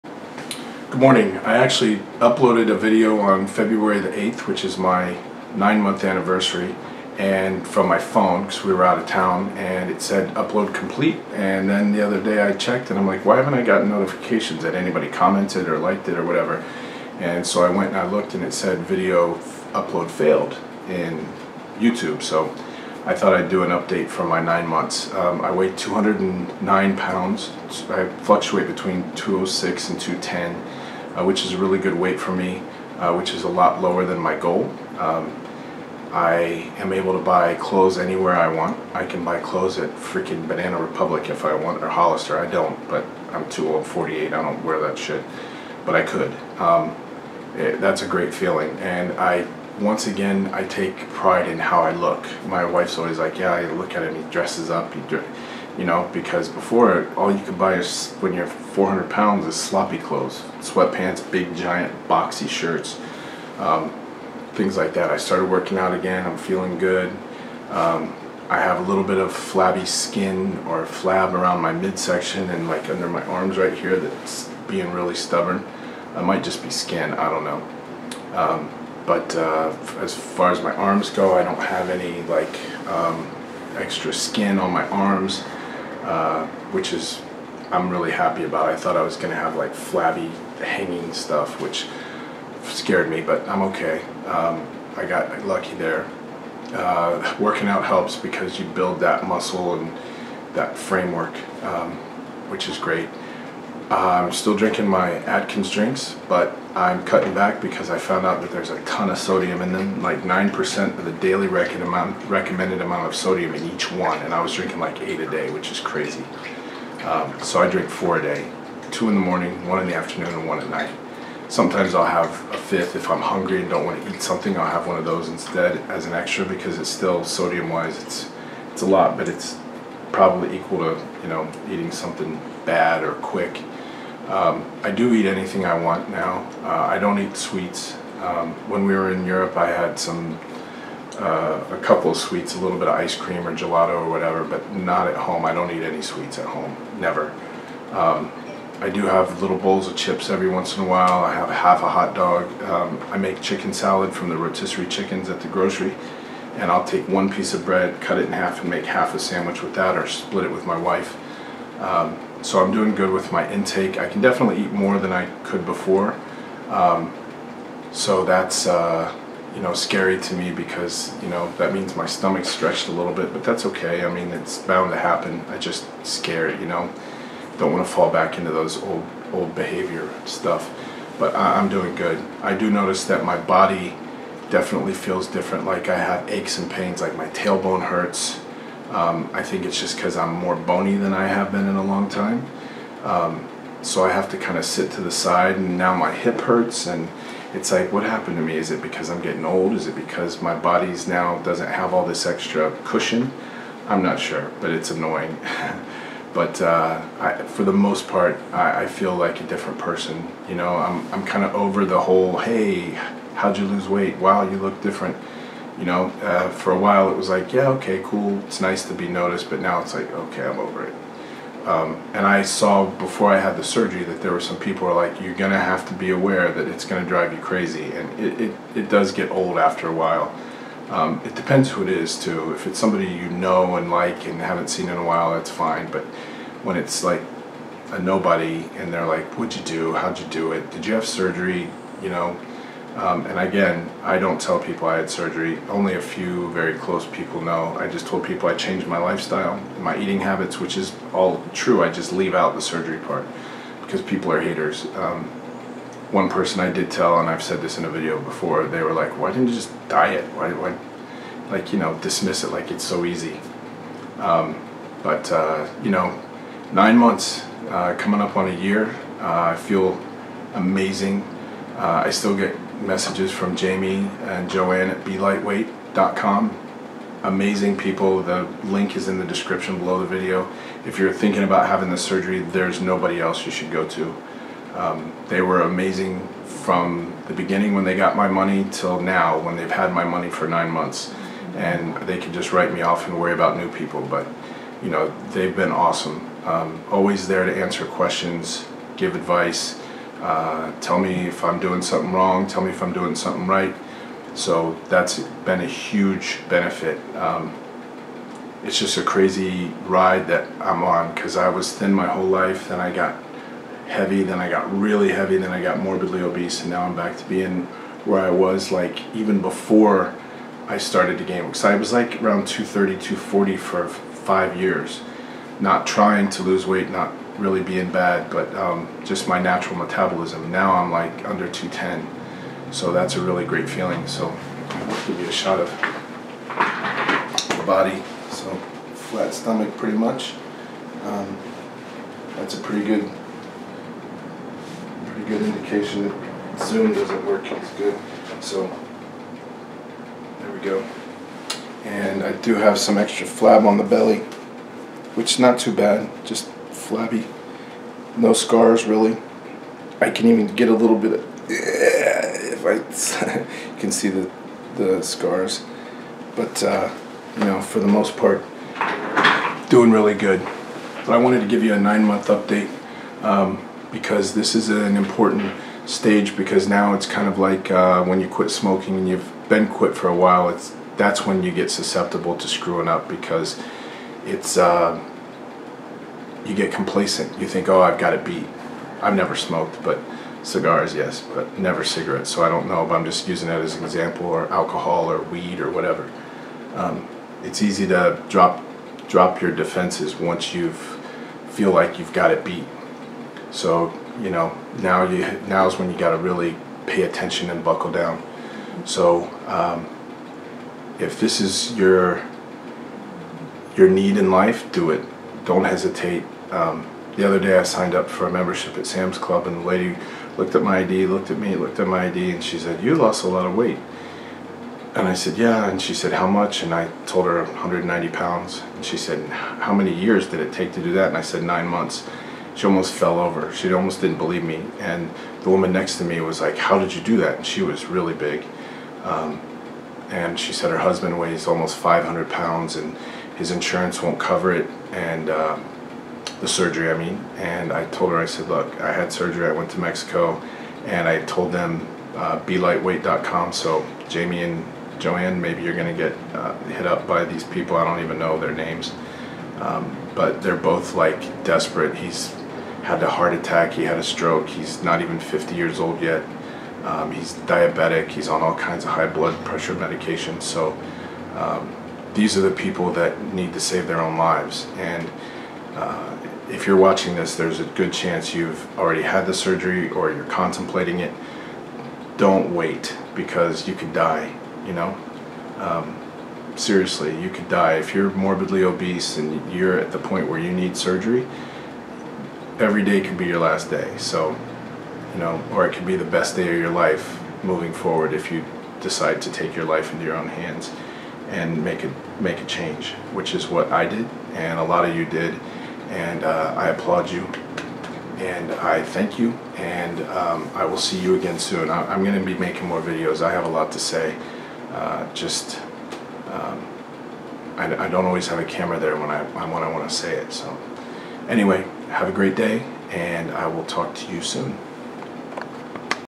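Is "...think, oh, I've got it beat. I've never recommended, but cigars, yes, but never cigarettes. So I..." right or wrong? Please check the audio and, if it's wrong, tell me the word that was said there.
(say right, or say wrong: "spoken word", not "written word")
wrong: "smoked", not "recommended".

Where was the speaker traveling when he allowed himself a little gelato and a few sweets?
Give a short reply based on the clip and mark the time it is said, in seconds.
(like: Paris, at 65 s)
Europe, at 139 s.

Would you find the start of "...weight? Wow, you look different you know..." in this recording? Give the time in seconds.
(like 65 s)
213 s.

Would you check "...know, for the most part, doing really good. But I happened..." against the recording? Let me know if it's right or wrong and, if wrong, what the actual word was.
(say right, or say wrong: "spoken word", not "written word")
wrong: "wanted", not "happened".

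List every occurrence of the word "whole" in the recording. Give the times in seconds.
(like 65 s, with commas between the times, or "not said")
212 s, 312 s.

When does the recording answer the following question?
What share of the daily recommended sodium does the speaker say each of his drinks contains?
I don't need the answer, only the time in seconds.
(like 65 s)
110 s.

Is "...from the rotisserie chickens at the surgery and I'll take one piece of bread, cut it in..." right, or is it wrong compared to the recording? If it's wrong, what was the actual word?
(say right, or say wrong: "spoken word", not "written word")
wrong: "grocery", not "surgery".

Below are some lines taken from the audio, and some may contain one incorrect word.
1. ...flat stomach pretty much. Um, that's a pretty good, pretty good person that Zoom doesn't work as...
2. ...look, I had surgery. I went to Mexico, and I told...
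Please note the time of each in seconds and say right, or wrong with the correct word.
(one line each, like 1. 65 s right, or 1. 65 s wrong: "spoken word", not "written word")
1. 338 s wrong: "indication", not "person"
2. 448 s right.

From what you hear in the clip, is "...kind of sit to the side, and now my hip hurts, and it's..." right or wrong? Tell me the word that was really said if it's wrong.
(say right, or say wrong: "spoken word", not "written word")
right.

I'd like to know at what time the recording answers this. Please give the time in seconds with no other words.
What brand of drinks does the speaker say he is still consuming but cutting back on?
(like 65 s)
105 s.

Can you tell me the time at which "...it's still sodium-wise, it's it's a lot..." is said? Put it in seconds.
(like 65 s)
126 s.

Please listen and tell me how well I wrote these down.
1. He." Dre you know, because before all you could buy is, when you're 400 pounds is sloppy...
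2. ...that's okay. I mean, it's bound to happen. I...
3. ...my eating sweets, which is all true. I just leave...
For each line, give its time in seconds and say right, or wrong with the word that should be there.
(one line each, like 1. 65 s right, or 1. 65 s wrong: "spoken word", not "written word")
1. 54 s right
2. 173 s right
3. 249 s wrong: "habits", not "sweets".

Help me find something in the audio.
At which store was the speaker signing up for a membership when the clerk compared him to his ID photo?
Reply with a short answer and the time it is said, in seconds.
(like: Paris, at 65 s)
Sam's Club, at 418 s.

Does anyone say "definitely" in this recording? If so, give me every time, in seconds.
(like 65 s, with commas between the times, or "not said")
164 s, 184 s.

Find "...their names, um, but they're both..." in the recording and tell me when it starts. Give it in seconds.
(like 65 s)
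458 s.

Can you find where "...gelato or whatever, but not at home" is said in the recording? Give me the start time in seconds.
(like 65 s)
143 s.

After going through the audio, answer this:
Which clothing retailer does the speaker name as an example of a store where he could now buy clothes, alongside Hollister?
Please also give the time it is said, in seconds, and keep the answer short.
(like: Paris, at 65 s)
Banana Republic, at 40 s.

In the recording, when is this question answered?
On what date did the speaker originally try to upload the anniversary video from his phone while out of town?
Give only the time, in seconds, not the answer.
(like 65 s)
3 s.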